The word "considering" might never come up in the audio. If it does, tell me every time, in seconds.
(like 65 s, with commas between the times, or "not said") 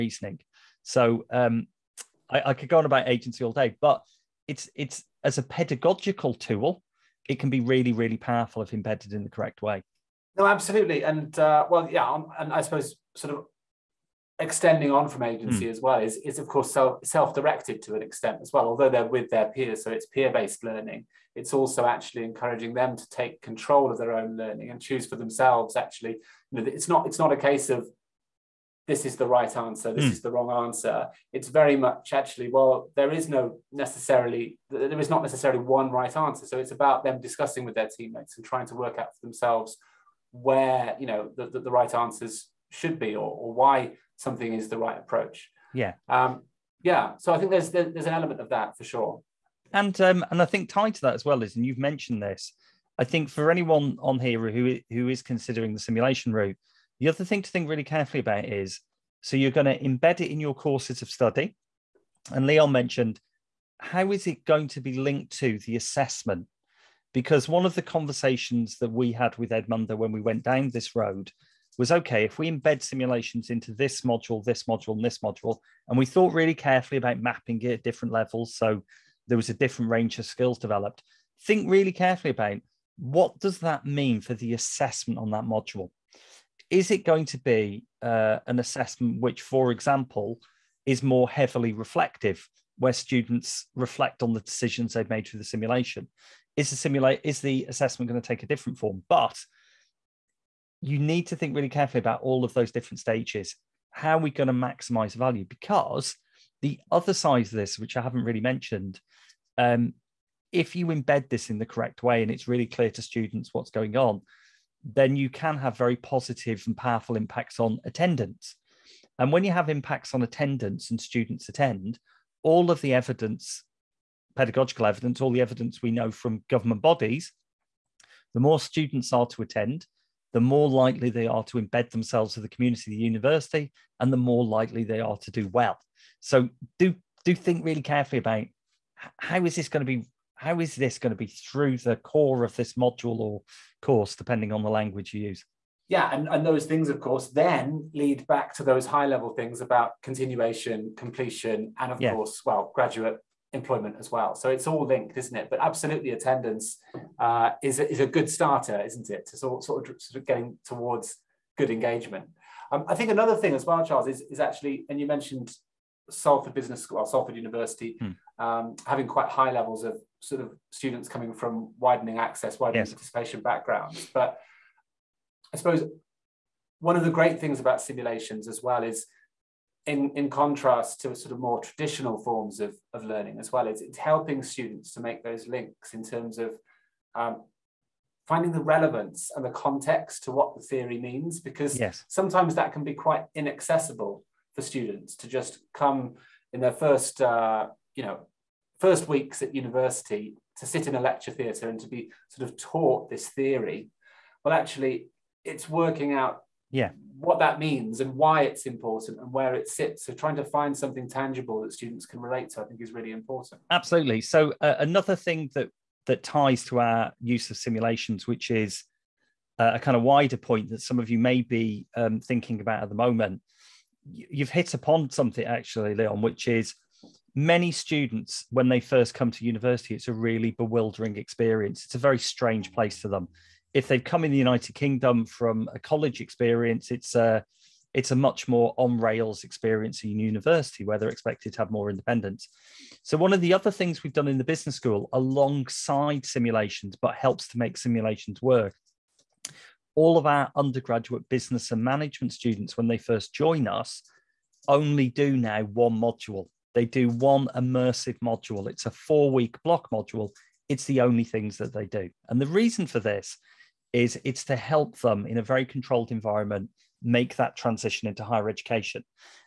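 55 s.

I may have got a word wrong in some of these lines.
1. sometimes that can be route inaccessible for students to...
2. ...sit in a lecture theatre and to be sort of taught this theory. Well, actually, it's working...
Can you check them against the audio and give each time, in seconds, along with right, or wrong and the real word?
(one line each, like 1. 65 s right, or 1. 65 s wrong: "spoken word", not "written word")
1. 192 s wrong: "quite", not "route"
2. 200 s right.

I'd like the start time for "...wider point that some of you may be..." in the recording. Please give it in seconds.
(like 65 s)
220 s.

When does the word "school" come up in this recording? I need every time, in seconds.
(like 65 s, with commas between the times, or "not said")
166 s, 244 s.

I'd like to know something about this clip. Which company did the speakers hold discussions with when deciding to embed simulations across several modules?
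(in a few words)
Edumundo.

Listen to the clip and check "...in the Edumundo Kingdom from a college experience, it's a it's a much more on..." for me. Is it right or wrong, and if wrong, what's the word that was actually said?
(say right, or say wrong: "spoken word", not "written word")
wrong: "United", not "Edumundo".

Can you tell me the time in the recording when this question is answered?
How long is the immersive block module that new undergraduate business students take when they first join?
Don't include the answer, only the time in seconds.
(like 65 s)
258 s.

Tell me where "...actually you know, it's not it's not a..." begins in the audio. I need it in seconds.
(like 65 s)
25 s.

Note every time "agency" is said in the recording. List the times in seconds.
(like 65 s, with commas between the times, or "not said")
3 s, 15 s.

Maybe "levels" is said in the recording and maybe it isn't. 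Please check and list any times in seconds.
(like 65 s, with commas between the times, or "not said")
78 s, 149 s, 169 s.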